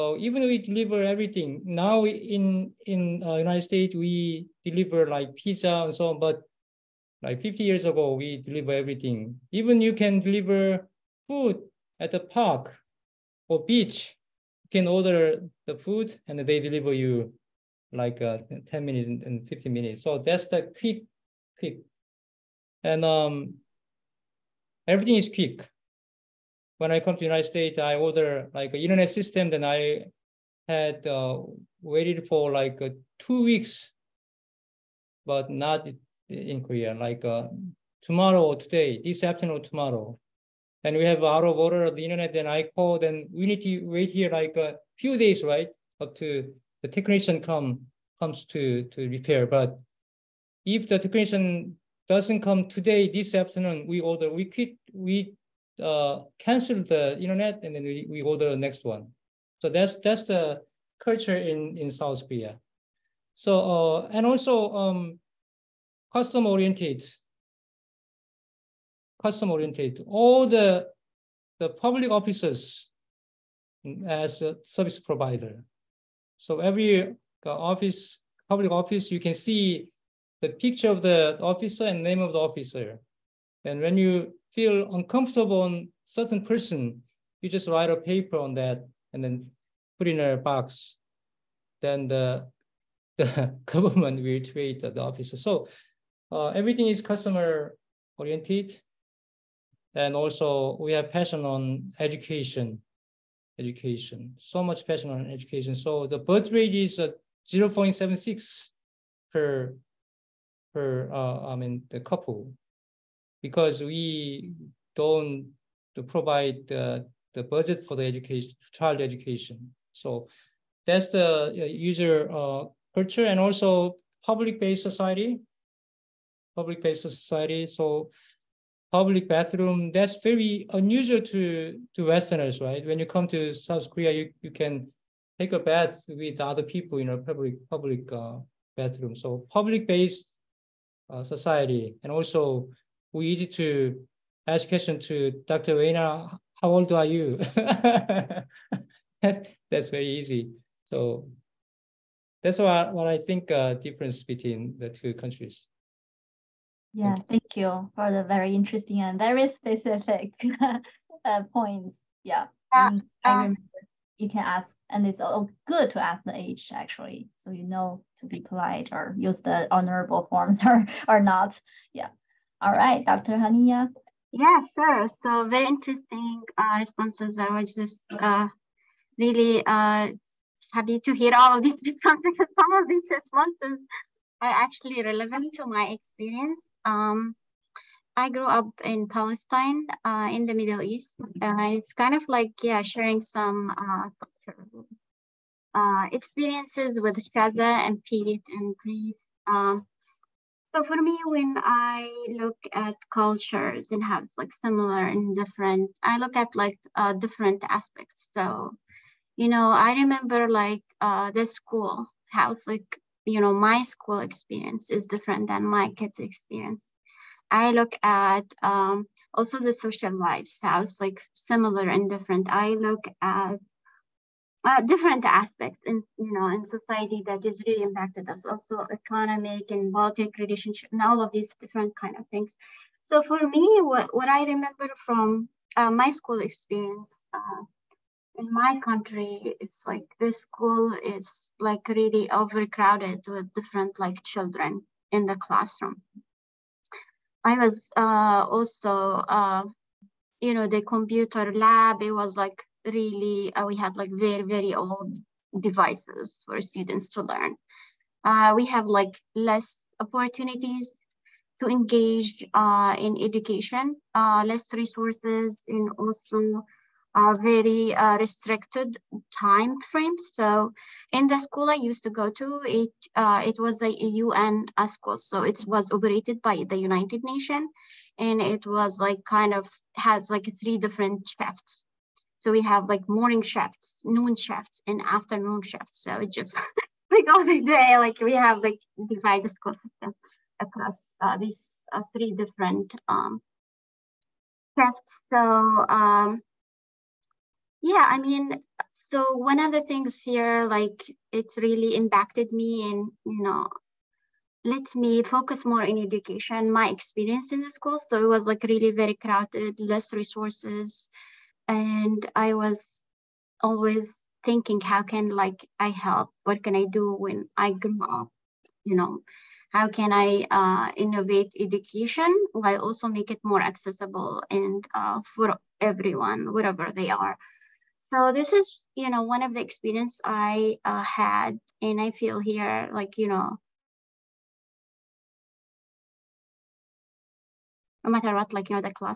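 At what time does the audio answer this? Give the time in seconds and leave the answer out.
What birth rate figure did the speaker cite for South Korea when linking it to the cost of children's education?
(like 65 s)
107 s.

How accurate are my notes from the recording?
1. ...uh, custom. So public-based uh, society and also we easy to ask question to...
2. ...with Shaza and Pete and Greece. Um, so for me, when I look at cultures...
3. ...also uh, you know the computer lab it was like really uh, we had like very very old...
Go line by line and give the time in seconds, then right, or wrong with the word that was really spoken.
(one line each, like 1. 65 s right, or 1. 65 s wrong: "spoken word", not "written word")
1. 138 s wrong: "bathroom", not "custom"
2. 196 s right
3. 248 s right.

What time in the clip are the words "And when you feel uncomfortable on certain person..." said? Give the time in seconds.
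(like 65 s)
83 s.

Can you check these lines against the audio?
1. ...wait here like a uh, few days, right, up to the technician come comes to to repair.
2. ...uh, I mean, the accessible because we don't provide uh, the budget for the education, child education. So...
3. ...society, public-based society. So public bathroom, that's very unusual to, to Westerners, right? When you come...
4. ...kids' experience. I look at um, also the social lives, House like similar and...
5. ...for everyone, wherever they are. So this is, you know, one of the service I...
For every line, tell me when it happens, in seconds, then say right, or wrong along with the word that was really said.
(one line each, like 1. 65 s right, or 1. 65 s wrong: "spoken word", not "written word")
1. 43 s right
2. 111 s wrong: "couple", not "accessible"
3. 124 s right
4. 215 s right
5. 325 s wrong: "experience", not "service".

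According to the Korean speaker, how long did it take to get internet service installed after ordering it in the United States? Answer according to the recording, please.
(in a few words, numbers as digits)
2 weeks.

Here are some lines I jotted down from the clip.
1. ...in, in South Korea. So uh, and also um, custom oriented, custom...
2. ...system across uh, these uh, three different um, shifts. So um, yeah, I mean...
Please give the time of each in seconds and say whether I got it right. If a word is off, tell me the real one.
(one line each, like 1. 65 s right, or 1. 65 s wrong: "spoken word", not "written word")
1. 61 s right
2. 289 s right.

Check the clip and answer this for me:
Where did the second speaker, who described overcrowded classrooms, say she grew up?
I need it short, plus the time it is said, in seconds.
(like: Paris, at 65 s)
Palestine, at 189 s.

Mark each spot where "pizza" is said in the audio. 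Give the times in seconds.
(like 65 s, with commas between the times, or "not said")
5 s.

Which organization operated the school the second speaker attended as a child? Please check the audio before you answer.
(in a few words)
United Nations.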